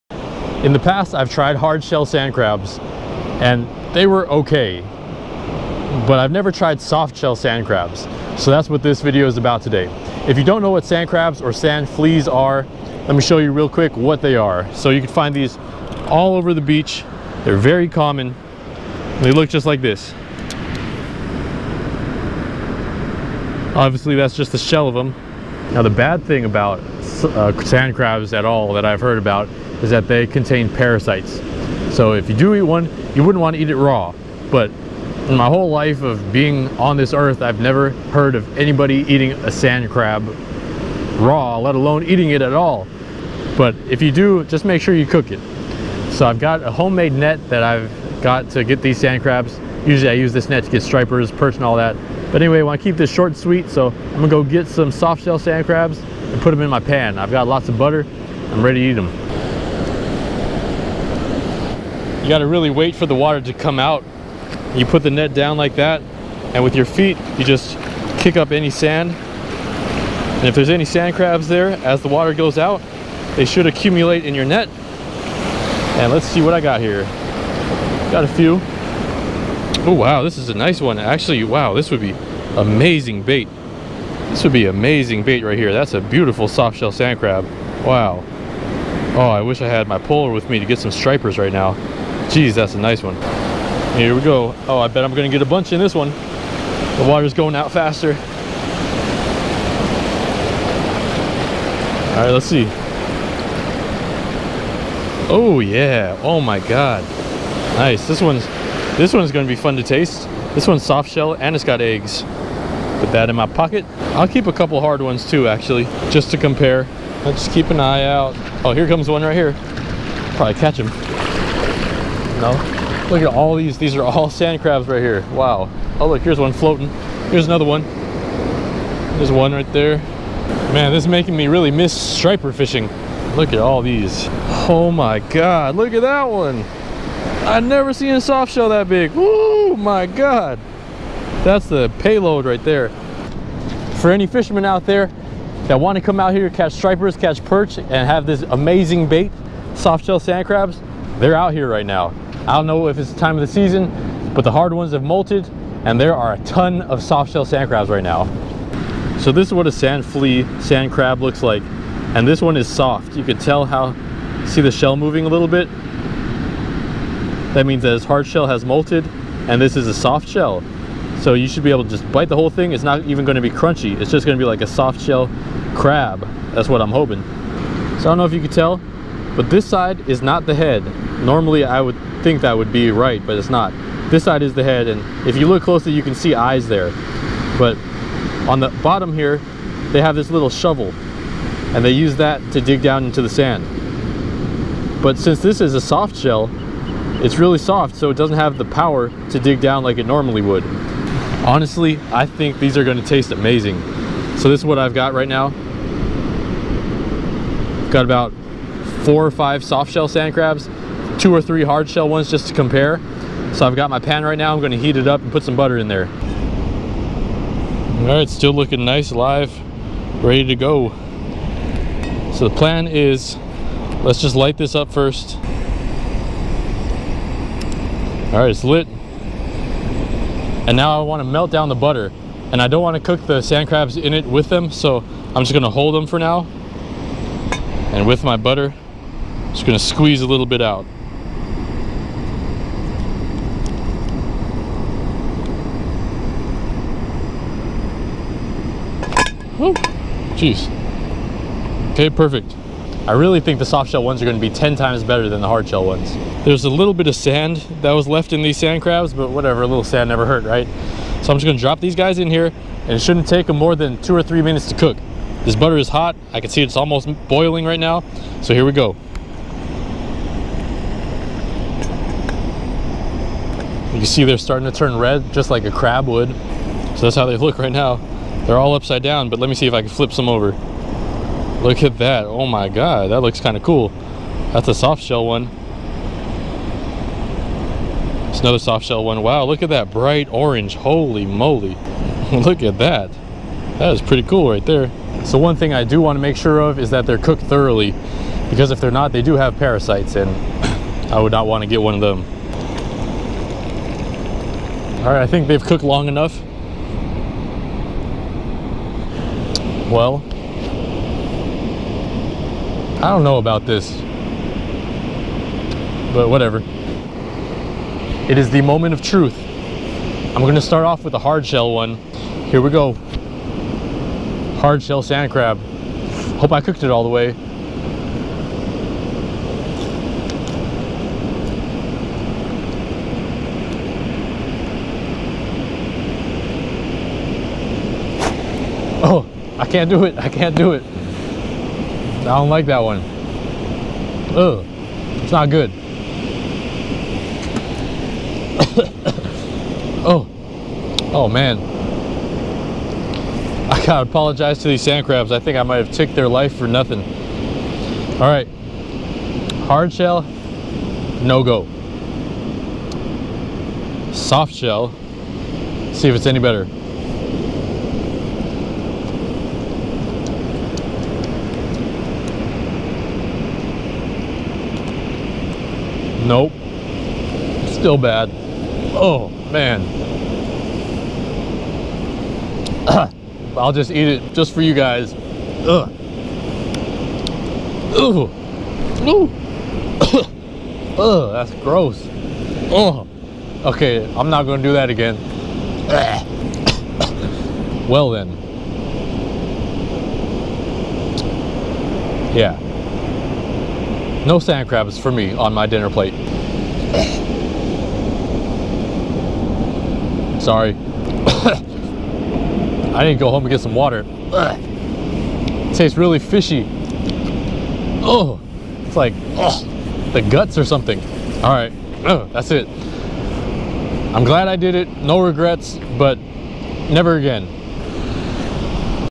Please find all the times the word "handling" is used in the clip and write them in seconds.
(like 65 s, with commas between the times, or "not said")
not said.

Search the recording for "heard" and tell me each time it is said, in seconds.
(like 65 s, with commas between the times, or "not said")
29 s, 38 s.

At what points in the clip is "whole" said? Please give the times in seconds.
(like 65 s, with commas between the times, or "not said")
35 s, 172 s.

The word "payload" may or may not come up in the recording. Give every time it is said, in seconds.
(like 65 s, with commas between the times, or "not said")
141 s.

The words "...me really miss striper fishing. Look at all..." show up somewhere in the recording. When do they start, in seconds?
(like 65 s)
131 s.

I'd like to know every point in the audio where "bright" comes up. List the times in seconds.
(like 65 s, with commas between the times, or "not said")
289 s.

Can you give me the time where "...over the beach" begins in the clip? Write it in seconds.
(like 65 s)
16 s.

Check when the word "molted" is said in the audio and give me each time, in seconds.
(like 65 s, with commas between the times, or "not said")
155 s, 168 s.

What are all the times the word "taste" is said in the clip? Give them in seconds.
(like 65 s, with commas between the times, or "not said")
109 s, 203 s, 415 s.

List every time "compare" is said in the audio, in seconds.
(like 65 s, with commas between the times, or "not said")
116 s, 212 s.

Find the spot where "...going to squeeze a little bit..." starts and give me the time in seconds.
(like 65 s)
239 s.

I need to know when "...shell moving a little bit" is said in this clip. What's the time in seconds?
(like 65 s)
164 s.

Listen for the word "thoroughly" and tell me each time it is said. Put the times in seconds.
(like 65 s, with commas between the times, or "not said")
297 s.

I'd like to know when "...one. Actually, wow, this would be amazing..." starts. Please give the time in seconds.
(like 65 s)
80 s.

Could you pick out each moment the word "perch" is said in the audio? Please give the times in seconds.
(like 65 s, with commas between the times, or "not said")
51 s, 147 s.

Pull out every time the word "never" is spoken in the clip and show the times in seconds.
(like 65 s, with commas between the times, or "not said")
6 s, 37 s, 137 s, 260 s, 426 s.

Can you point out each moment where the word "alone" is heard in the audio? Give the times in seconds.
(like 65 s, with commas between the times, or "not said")
41 s.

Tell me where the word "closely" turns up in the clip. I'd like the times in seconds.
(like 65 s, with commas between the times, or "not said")
185 s.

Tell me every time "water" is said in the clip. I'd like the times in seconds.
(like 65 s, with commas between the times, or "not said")
63 s, 72 s, 97 s, 413 s.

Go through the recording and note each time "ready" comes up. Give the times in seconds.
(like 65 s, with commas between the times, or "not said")
58 s, 220 s.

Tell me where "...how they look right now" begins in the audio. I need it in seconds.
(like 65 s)
277 s.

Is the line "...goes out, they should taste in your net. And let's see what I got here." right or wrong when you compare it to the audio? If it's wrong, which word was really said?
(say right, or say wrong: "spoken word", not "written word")
wrong: "accumulate", not "taste".